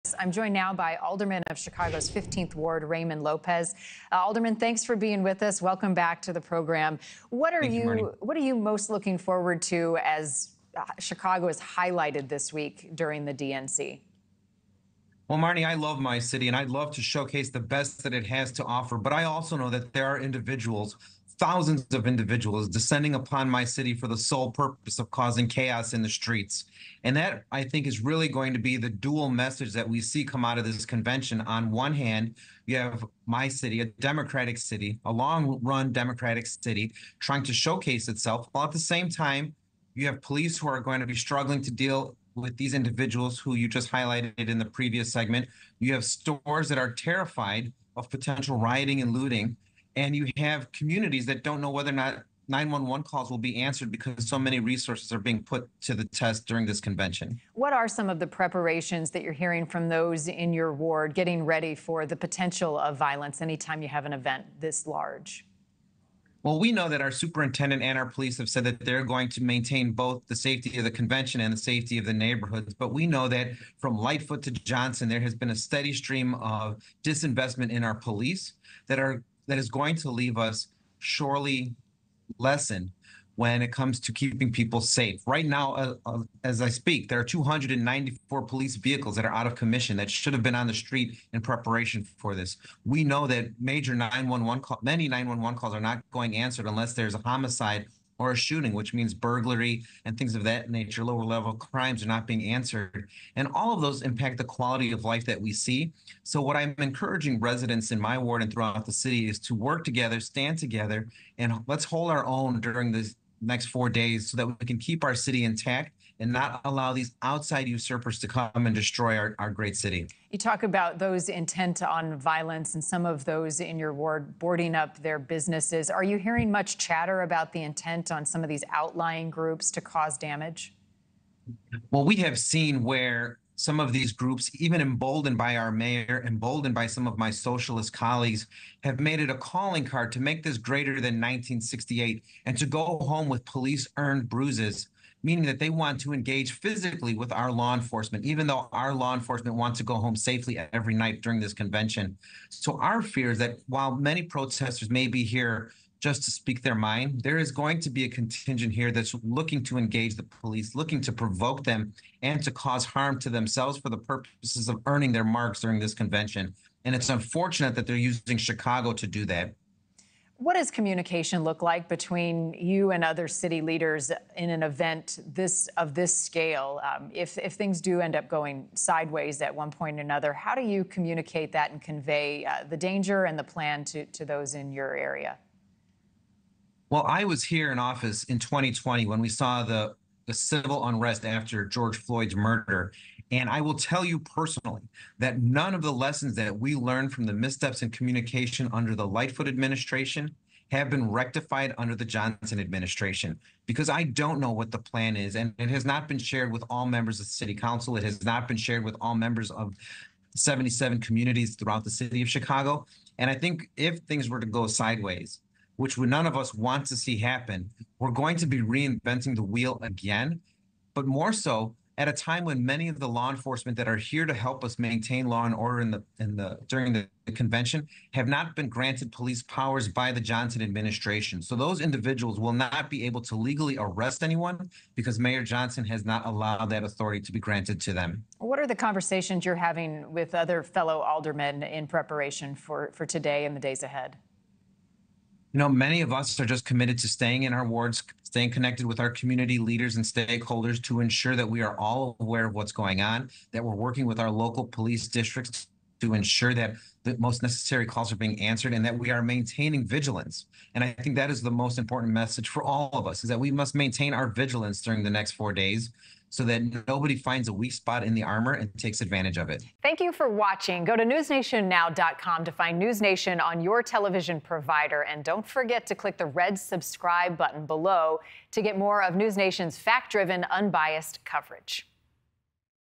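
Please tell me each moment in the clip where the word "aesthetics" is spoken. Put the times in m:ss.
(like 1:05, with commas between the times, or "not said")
not said.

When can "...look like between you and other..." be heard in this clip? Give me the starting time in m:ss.
2:51.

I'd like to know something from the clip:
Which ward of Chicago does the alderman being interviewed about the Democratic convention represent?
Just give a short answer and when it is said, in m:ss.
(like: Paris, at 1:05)
15th Ward, at 0:02.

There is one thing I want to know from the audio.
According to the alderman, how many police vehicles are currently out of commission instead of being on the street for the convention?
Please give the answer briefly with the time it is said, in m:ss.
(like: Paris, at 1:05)
294, at 1:27.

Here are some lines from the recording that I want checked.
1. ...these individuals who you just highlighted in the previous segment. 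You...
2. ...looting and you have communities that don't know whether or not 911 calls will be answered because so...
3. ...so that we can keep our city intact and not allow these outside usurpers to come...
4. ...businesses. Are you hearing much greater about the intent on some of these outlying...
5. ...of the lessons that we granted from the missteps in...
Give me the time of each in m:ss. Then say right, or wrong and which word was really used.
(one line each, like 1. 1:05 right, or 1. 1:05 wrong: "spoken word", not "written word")
1. 0:42 right
2. 0:49 right
3. 1:54 right
4. 2:05 wrong: "chatter", not "greater"
5. 3:15 wrong: "learned", not "granted".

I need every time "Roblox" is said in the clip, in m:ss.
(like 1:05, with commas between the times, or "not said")
not said.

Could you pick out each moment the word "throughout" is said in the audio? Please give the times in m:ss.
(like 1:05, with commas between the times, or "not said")
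1:48, 3:31.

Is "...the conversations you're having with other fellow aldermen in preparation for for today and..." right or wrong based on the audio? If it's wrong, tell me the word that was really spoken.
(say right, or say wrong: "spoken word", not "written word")
right.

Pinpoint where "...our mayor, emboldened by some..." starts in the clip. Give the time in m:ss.
2:15.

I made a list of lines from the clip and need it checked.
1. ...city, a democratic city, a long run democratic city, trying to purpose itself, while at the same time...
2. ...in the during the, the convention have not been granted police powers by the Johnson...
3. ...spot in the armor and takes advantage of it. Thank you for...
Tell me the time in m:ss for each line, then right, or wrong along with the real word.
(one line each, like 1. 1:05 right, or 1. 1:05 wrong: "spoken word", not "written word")
1. 0:33 wrong: "showcase", not "purpose"
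2. 3:46 right
3. 4:27 right.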